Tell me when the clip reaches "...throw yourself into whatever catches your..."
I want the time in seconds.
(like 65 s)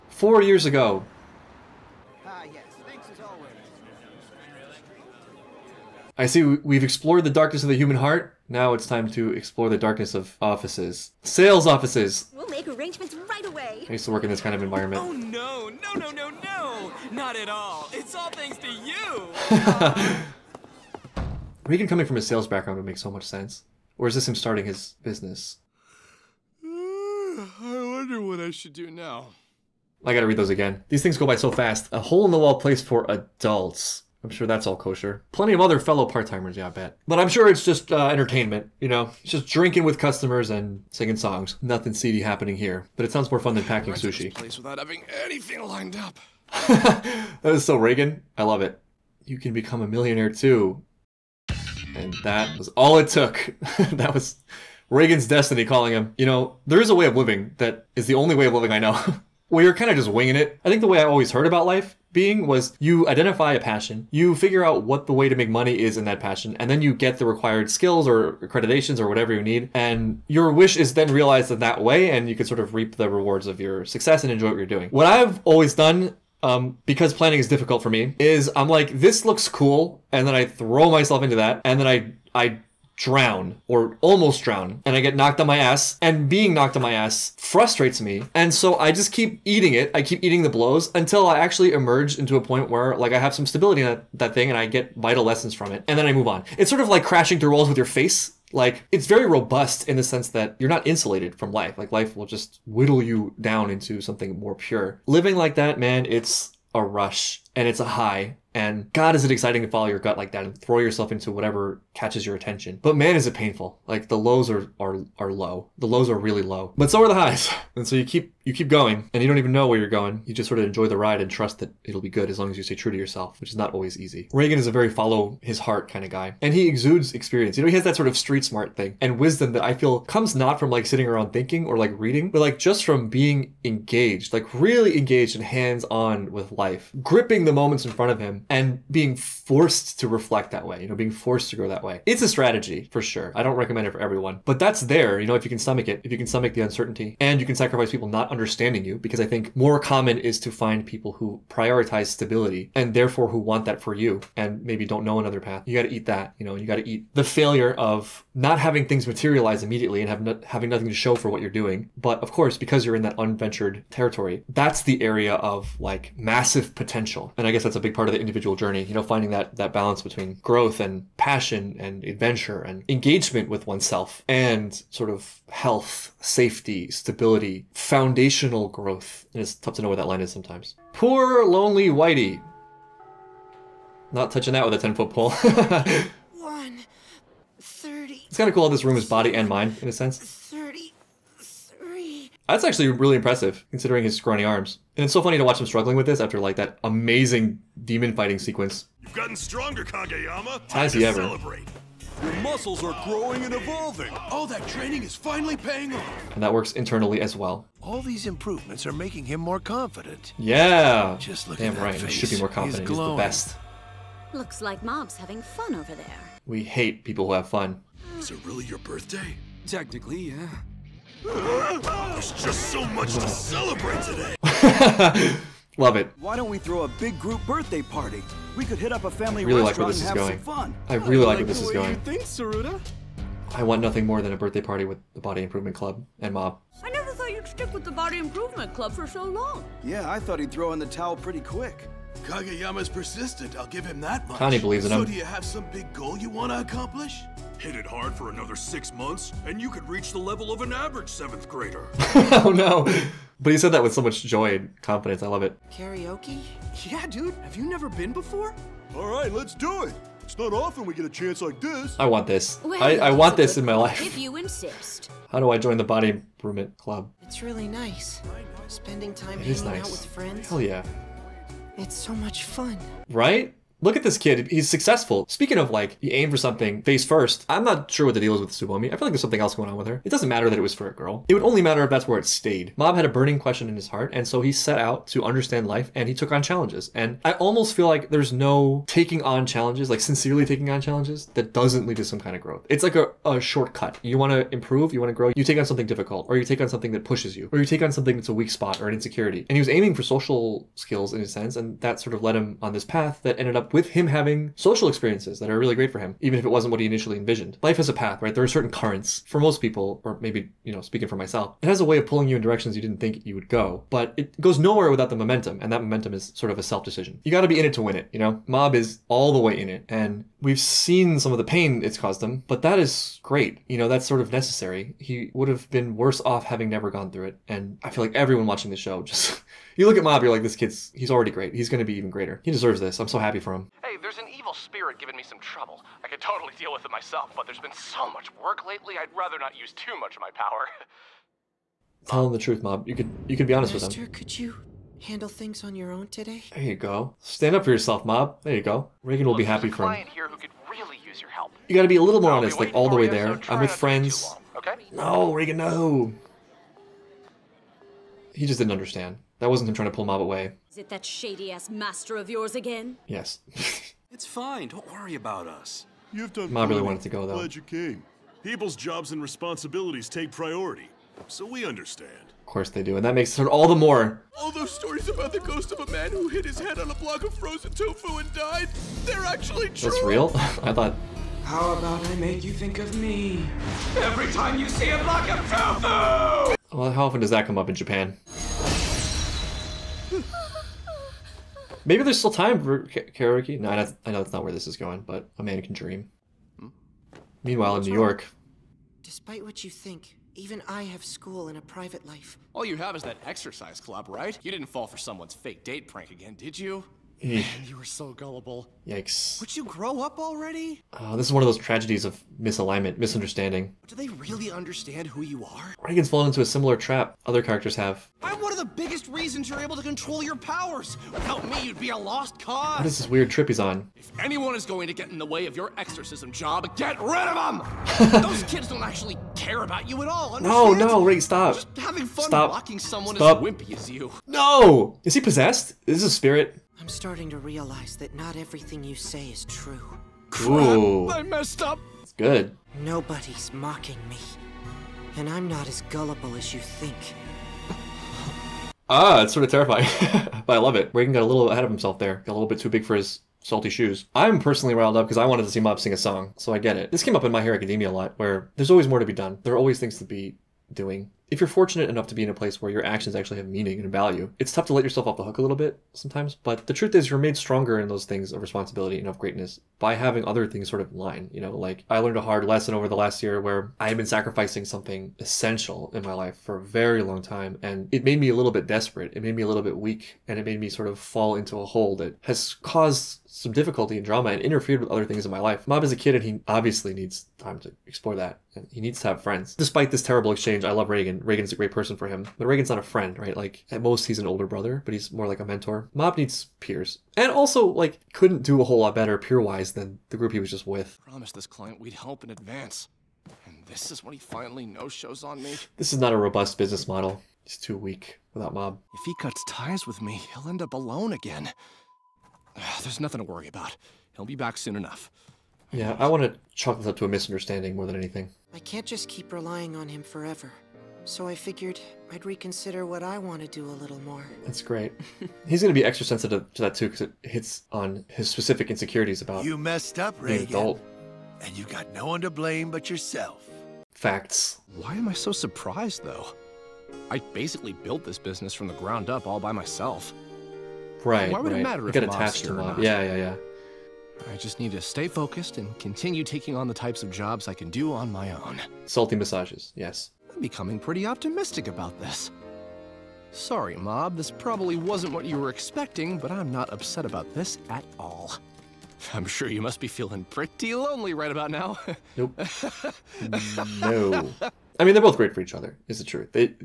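110 s.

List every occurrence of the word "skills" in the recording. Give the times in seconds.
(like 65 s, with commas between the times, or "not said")
67 s, 300 s.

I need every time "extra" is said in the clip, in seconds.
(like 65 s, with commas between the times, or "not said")
525 s.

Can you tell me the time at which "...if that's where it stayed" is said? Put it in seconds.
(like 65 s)
281 s.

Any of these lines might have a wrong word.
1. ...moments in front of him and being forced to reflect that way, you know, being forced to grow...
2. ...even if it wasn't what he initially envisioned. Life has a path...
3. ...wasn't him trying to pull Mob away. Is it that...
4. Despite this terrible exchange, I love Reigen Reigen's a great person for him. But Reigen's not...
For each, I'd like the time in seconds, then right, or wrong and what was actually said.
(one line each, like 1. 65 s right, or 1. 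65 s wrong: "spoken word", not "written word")
1. 137 s right
2. 306 s right
3. 359 s right
4. 489 s right.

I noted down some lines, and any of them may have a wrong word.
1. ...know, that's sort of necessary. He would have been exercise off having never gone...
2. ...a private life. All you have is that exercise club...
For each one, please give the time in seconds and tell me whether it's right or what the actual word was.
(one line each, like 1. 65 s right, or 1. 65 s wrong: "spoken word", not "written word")
1. 323 s wrong: "worse", not "exercise"
2. 401 s right.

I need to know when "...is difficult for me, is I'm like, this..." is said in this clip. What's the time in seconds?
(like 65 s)
77 s.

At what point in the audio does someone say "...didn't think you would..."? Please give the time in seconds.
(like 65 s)
312 s.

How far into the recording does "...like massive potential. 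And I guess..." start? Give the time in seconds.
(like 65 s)
165 s.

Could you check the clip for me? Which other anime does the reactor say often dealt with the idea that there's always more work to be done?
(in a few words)
My Hero Academia.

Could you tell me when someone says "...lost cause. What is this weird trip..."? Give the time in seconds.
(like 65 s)
421 s.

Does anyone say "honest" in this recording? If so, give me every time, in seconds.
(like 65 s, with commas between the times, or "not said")
343 s, 352 s.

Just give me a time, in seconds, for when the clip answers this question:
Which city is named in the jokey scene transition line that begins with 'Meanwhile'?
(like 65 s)
397 s.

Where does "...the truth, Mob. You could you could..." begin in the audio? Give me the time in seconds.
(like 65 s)
342 s.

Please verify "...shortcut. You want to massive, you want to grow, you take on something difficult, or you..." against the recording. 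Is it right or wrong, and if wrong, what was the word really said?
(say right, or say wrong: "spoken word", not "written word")
wrong: "improve", not "massive".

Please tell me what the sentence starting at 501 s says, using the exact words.
Promised this client we'd help in advance.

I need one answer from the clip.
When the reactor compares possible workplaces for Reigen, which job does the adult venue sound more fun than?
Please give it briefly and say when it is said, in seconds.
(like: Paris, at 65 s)
packing sushi, at 43 s.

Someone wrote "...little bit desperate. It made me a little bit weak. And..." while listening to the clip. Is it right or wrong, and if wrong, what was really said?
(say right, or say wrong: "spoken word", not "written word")
right.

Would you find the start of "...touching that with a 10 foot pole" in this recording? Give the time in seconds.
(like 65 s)
184 s.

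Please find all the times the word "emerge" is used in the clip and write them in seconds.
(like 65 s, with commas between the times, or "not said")
91 s.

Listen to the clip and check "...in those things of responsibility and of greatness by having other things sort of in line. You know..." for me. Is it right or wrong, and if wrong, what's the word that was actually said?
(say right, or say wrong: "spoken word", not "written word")
right.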